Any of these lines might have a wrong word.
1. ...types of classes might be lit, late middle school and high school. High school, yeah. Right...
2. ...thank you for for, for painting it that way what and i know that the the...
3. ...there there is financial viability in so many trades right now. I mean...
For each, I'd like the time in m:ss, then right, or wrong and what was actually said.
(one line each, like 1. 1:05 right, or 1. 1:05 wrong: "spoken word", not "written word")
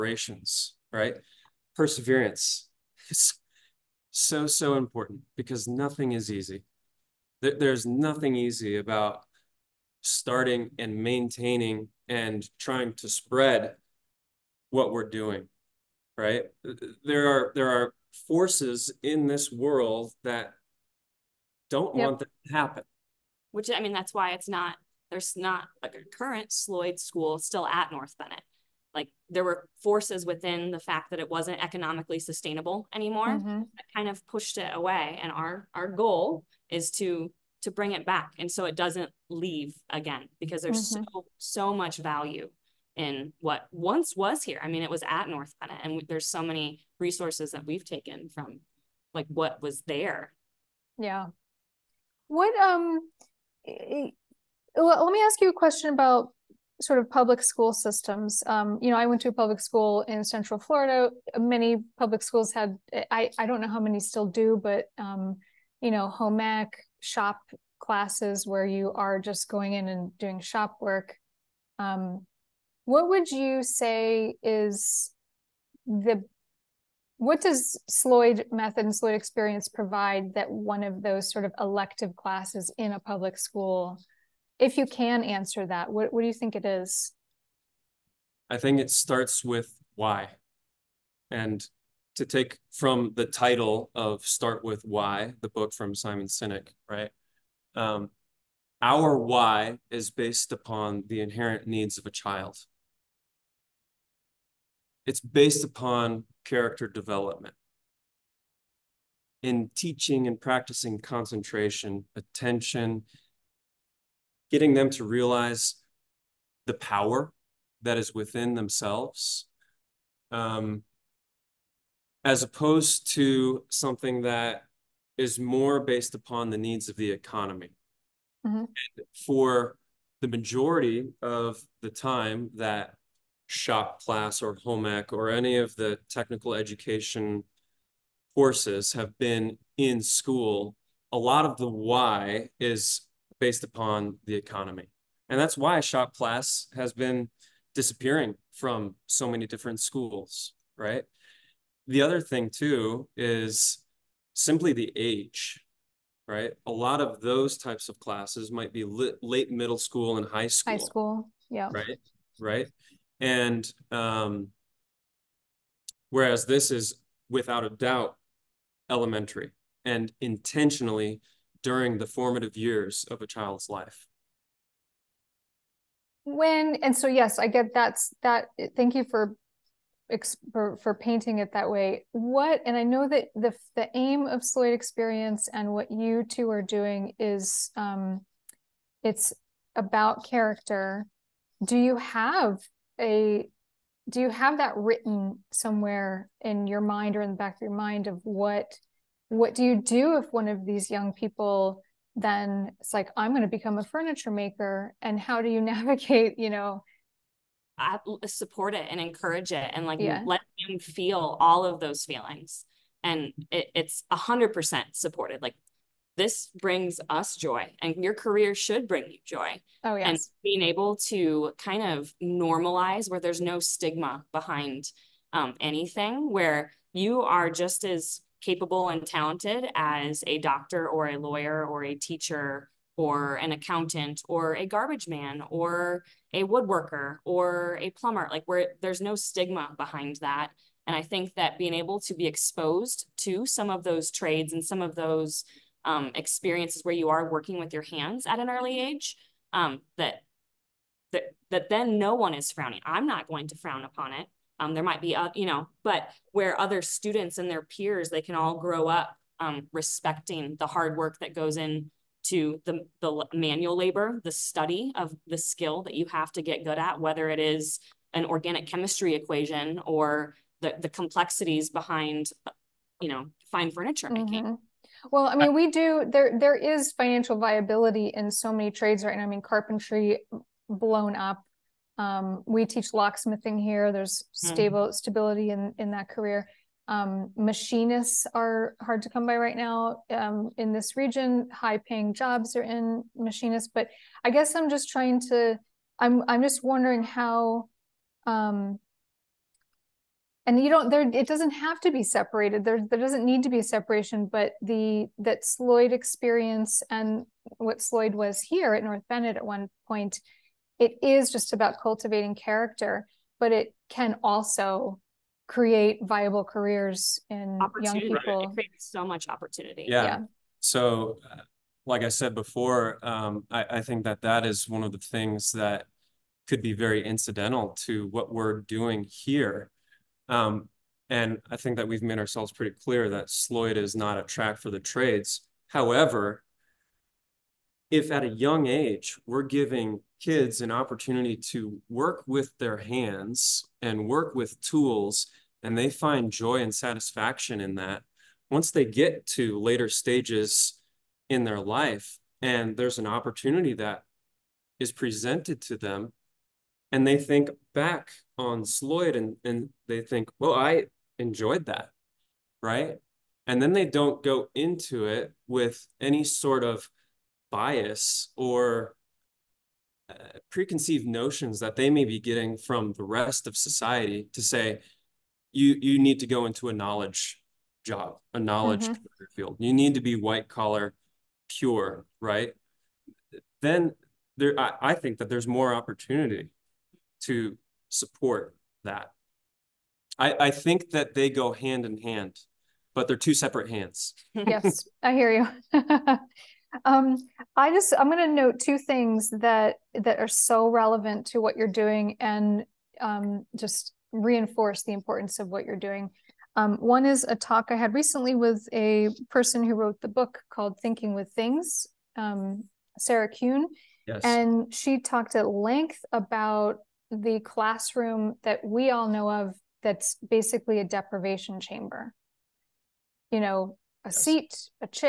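1. 2:37 right
2. 2:58 right
3. 4:36 right.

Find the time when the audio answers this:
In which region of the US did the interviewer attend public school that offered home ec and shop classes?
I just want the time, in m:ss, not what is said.
1:00.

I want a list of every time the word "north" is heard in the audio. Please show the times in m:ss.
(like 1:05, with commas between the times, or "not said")
0:27, 0:45, 5:08.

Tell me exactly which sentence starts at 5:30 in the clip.
Um, and I think that we've made ourselves pretty clear that Sloyd is not a track for the trades.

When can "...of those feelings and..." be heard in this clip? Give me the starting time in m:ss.
3:31.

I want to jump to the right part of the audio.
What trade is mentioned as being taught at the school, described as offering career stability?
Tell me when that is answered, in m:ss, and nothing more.
4:42.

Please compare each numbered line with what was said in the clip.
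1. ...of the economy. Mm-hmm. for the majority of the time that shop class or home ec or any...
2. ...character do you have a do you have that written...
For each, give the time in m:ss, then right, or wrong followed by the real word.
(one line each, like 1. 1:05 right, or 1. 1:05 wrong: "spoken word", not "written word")
1. 2:06 right
2. 3:10 right.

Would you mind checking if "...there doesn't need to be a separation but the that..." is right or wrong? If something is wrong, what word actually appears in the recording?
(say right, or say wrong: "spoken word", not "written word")
right.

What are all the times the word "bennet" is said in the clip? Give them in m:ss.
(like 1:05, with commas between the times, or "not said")
0:28, 0:45, 5:09.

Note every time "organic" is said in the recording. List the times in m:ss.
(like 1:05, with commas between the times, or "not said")
4:28.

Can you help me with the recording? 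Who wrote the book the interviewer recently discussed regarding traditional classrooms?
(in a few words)
Sarah Kuhn.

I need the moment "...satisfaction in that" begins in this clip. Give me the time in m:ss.
5:46.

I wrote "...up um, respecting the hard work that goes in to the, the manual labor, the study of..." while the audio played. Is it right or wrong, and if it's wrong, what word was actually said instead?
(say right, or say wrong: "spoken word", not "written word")
right.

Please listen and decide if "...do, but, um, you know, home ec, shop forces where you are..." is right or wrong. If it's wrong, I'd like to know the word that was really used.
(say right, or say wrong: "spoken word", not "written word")
wrong: "classes", not "forces".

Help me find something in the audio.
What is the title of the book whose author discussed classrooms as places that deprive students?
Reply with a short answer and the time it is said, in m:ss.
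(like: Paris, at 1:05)
Thinking with Things, at 6:50.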